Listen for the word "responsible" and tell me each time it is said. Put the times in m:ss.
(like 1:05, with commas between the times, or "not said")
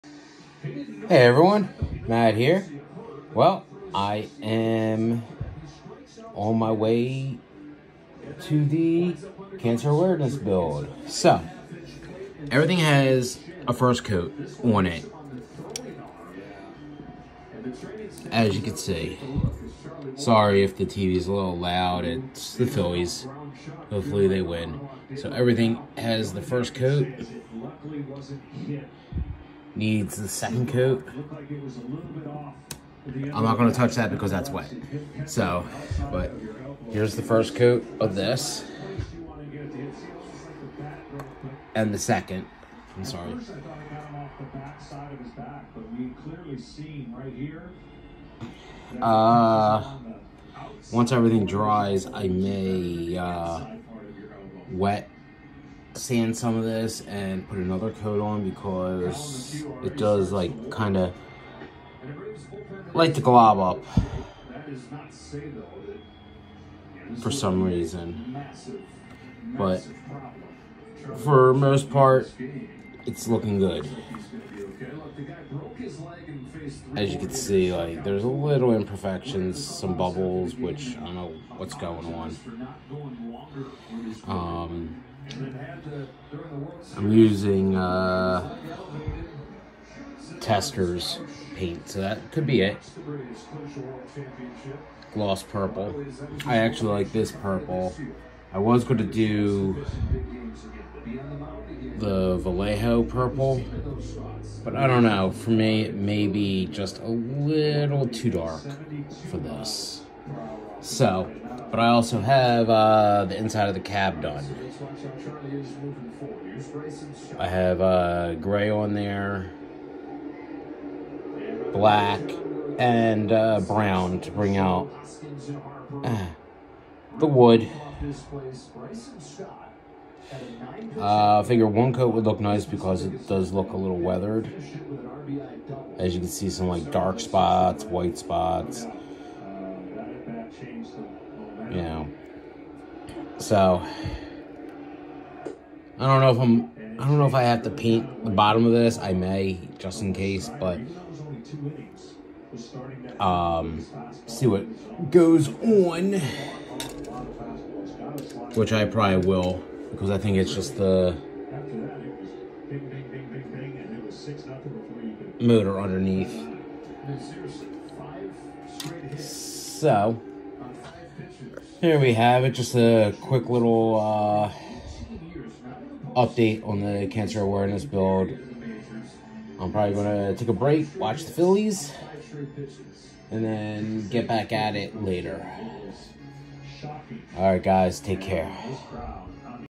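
not said.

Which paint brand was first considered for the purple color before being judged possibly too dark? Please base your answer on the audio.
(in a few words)
Vallejo.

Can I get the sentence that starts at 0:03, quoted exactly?
Well, I am on my way to the cancer awareness build.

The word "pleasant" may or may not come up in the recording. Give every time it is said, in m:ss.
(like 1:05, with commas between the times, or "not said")
not said.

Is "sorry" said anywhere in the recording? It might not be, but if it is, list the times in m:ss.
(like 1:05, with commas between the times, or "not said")
0:20, 0:43.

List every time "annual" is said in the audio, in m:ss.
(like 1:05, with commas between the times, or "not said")
not said.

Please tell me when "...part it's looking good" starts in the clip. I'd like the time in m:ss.
1:11.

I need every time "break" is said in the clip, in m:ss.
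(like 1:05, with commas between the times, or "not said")
3:00.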